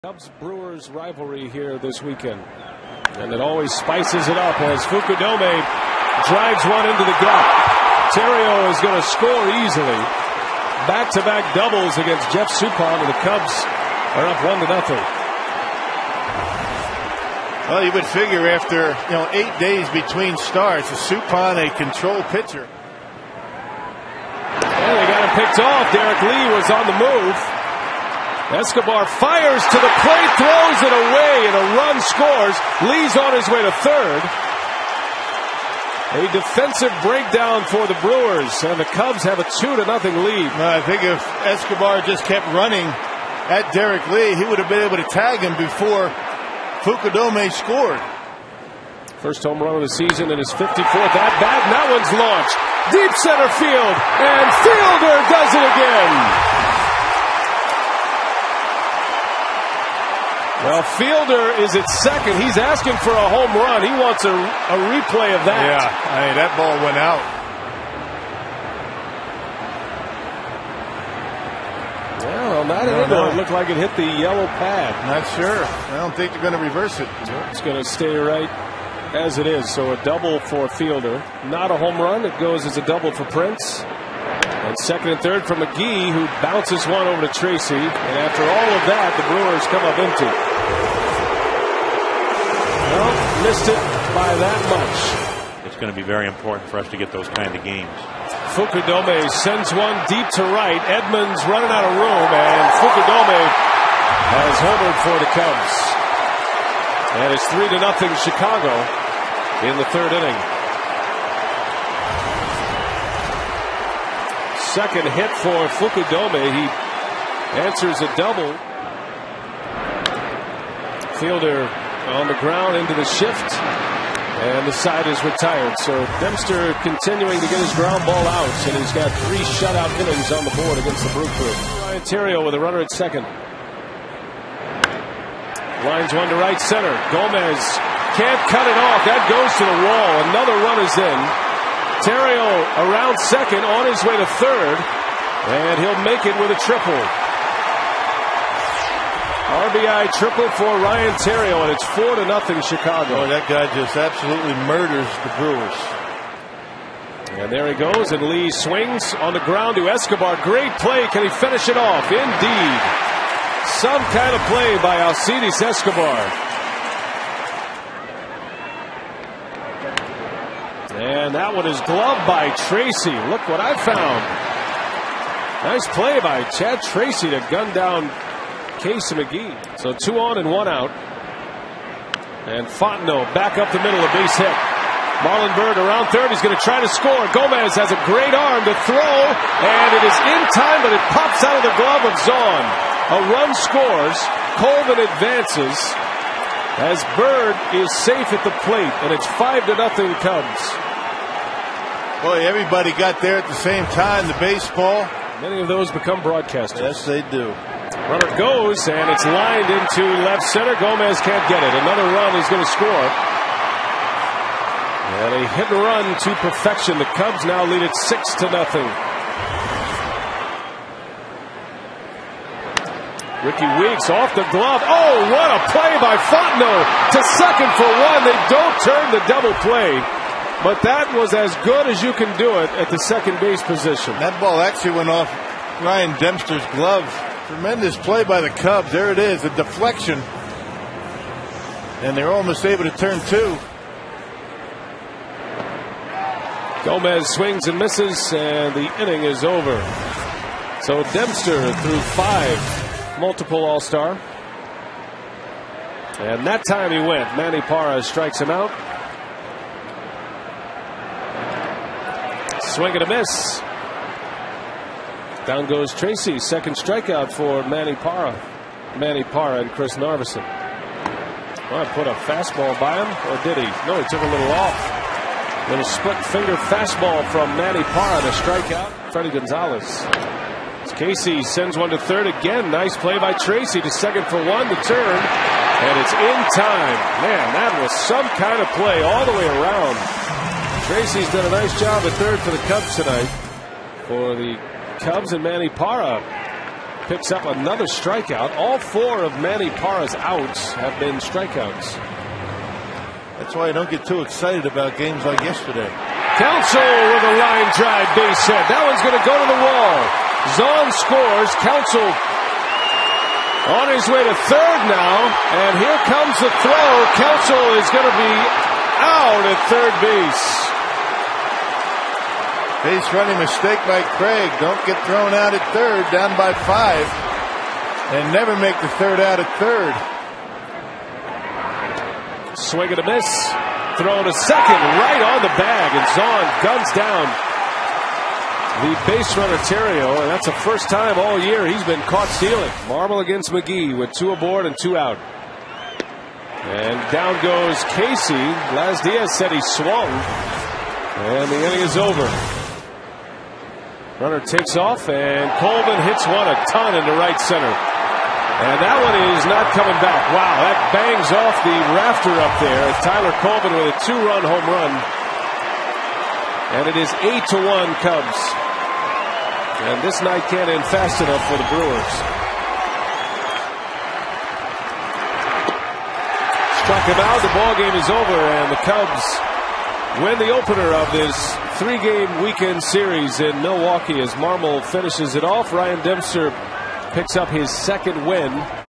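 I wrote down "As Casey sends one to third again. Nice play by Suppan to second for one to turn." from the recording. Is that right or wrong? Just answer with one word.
wrong.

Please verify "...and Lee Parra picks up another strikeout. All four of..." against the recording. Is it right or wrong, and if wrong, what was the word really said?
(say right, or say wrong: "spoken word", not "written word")
wrong: "Manny", not "Lee".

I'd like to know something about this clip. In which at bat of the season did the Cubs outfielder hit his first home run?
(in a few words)
54th.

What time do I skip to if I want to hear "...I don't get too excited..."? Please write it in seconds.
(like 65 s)
303 s.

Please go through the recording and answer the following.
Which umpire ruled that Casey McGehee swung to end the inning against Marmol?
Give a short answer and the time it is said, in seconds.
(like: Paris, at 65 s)
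Laz Diaz, at 348 s.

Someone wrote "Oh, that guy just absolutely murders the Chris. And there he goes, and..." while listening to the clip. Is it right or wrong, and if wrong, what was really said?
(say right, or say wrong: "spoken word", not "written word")
wrong: "Brewers", not "Chris".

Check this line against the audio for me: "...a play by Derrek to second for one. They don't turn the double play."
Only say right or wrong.
wrong.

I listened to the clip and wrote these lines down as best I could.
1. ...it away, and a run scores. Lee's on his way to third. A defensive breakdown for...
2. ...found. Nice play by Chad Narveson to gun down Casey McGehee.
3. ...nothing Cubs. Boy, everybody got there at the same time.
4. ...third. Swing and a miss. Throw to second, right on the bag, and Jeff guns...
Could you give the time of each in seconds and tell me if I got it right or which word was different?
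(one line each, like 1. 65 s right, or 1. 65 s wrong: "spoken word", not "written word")
1. 30 s right
2. 173 s wrong: "Tracy", not "Narveson"
3. 199 s right
4. 329 s wrong: "Zaun", not "Jeff".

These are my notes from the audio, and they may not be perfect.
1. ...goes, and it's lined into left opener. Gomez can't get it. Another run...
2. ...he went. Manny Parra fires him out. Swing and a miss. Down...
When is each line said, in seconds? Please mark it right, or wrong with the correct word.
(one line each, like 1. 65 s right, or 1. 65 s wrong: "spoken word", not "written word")
1. 208 s wrong: "center", not "opener"
2. 256 s wrong: "strikes", not "fires".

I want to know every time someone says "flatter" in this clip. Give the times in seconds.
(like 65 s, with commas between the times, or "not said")
not said.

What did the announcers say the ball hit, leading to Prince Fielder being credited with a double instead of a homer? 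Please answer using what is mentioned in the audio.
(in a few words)
the yellow pad.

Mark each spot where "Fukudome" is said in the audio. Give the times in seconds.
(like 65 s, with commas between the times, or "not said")
4 s, 46 s, 98 s, 102 s, 115 s.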